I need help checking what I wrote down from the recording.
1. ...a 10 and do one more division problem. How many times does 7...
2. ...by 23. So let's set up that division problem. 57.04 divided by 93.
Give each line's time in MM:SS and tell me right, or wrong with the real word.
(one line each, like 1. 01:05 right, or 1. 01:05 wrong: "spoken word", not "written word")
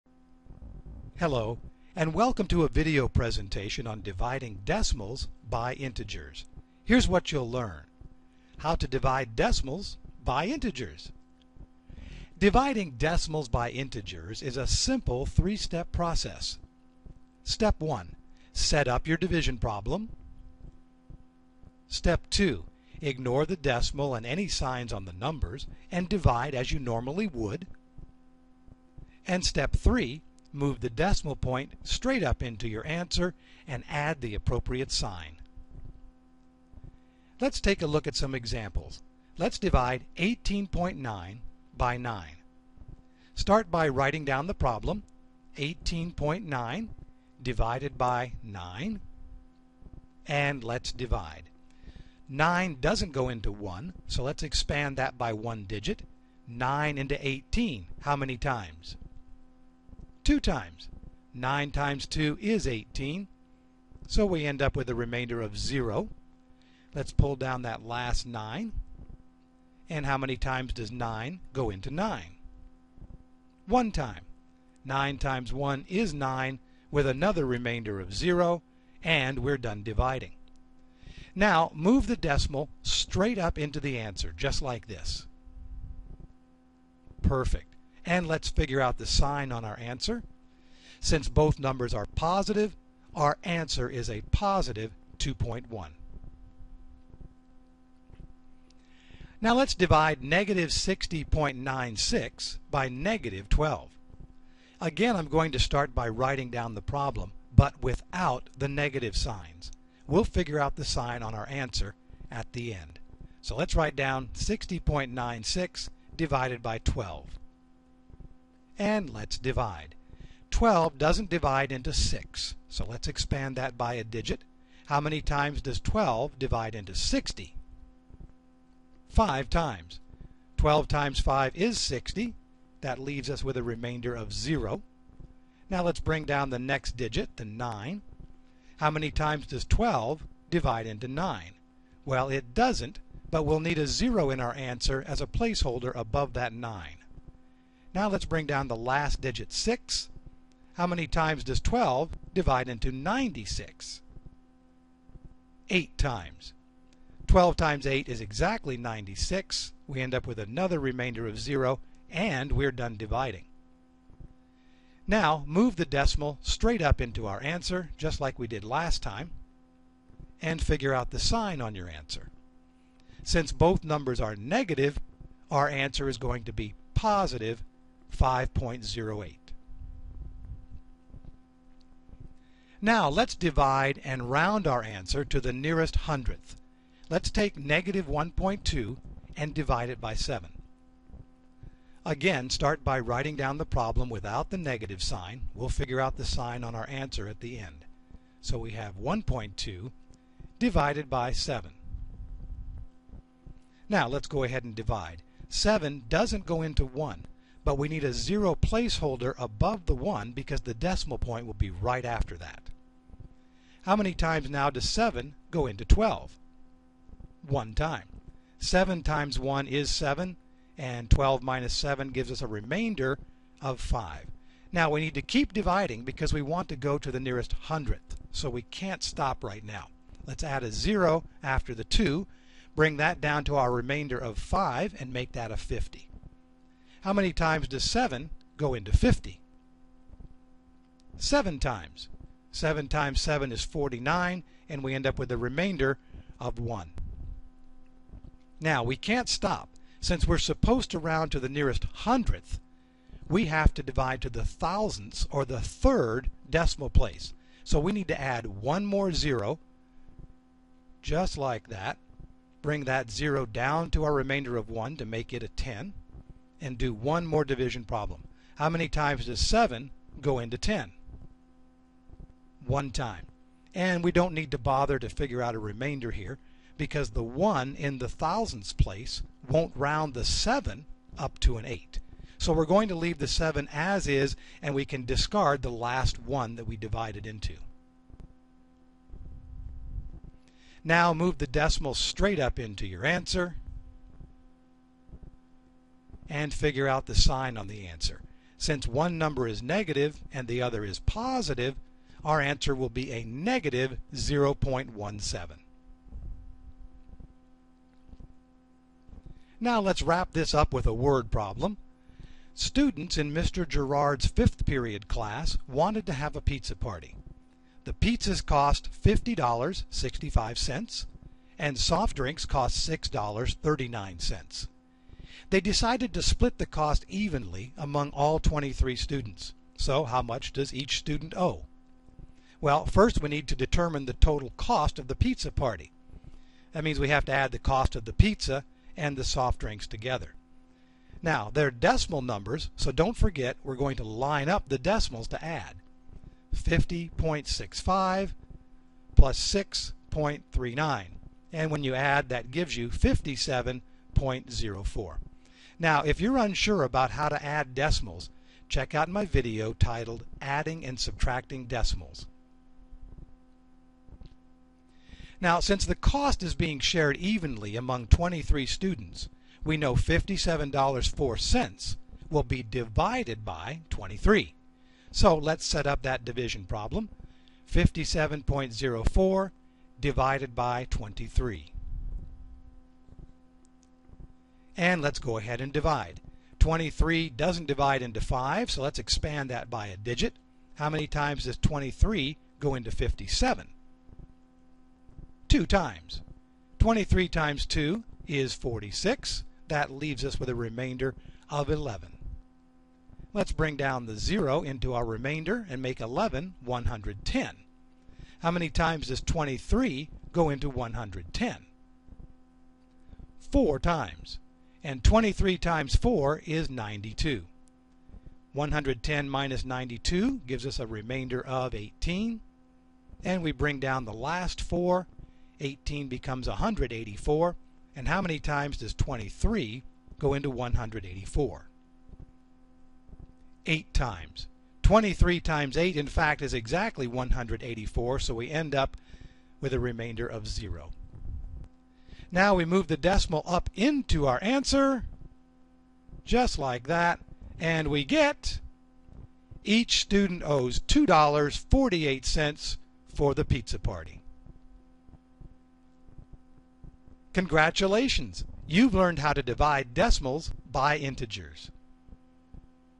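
1. 04:25 right
2. 06:13 wrong: "23", not "93".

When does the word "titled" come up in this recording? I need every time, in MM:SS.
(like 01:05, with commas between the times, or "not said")
05:59.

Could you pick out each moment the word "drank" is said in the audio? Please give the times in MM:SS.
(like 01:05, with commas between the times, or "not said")
not said.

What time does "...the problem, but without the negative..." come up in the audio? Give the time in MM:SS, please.
01:46.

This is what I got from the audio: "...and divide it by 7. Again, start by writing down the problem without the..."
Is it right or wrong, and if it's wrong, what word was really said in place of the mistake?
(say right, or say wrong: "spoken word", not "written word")
right.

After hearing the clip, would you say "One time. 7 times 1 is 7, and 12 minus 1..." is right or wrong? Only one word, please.
wrong.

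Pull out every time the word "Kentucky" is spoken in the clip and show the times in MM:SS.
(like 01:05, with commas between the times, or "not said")
not said.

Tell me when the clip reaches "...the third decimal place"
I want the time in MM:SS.
04:15.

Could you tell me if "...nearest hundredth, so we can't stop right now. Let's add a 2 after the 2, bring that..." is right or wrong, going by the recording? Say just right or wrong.
wrong.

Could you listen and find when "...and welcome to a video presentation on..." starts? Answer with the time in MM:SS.
00:01.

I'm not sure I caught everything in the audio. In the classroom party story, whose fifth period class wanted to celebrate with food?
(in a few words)
Mr. Gerard.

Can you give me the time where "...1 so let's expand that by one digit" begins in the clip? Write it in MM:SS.
00:53.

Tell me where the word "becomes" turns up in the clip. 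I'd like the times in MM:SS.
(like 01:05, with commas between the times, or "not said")
07:06.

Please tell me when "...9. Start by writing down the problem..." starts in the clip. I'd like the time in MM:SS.
00:41.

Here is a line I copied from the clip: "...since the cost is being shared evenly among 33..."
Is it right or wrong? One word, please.
wrong.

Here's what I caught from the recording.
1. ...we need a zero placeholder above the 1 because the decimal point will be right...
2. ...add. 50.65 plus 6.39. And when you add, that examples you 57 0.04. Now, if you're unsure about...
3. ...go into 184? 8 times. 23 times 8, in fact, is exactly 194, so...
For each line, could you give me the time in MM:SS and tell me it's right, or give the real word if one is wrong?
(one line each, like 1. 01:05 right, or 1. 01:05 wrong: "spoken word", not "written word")
1. 03:27 right
2. 05:45 wrong: "gives", not "examples"
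3. 07:10 wrong: "184", not "194".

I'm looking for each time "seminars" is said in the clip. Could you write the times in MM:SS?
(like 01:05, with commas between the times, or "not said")
not said.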